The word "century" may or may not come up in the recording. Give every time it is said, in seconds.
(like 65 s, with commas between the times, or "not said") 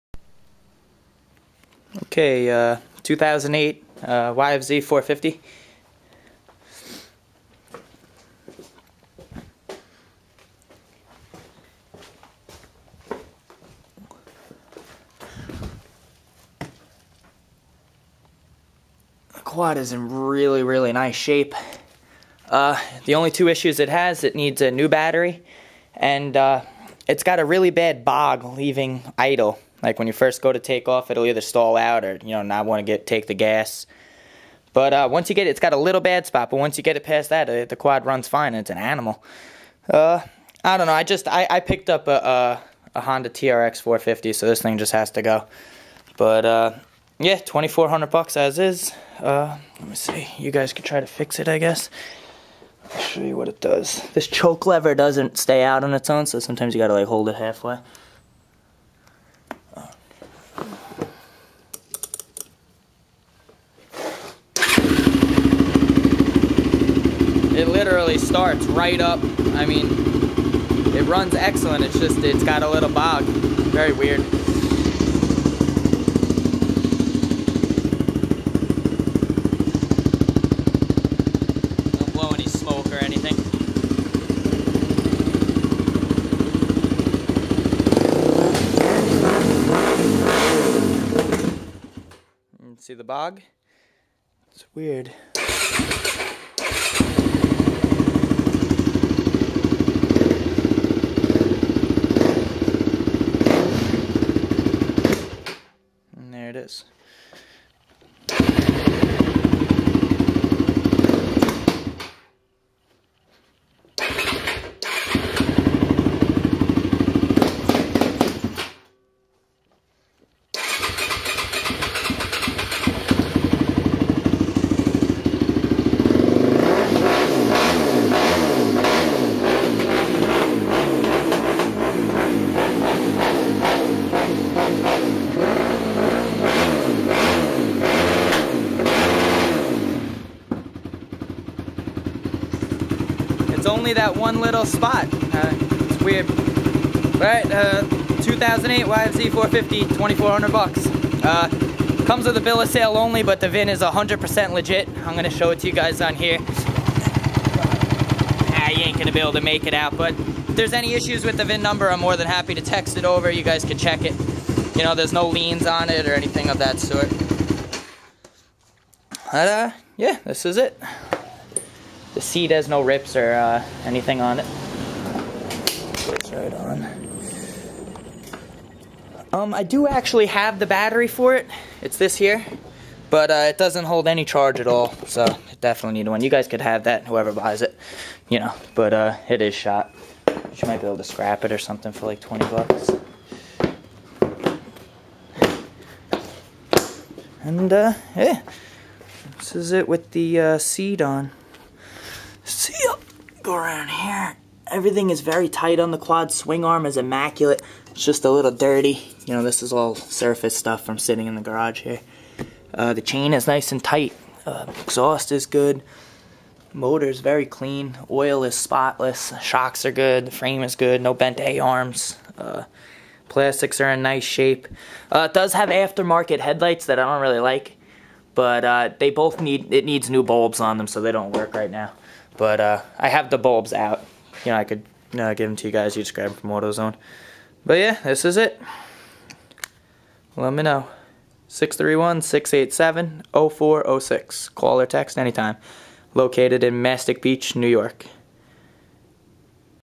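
not said.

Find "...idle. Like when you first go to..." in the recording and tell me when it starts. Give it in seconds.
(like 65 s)
29 s.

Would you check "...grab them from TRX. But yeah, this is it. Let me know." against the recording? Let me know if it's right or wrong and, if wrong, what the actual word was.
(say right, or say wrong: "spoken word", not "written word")
wrong: "AutoZone", not "TRX".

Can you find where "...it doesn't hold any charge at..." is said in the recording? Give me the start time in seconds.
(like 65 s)
183 s.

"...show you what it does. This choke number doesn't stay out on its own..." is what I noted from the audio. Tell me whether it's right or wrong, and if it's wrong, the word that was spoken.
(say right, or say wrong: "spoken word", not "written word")
wrong: "lever", not "number".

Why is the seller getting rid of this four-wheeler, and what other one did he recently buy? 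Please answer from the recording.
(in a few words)
Honda TRX 450.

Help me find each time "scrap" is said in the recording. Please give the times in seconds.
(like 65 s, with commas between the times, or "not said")
191 s.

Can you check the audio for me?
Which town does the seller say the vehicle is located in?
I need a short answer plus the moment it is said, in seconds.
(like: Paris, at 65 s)
Mastic Beach, at 246 s.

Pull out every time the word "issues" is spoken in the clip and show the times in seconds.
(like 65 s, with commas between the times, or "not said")
23 s, 160 s.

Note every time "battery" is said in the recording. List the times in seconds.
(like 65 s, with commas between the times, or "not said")
24 s, 180 s.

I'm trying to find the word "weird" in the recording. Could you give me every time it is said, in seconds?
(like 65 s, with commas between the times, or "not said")
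73 s, 94 s, 146 s.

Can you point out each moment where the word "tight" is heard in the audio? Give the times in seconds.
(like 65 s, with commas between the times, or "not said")
205 s, 213 s.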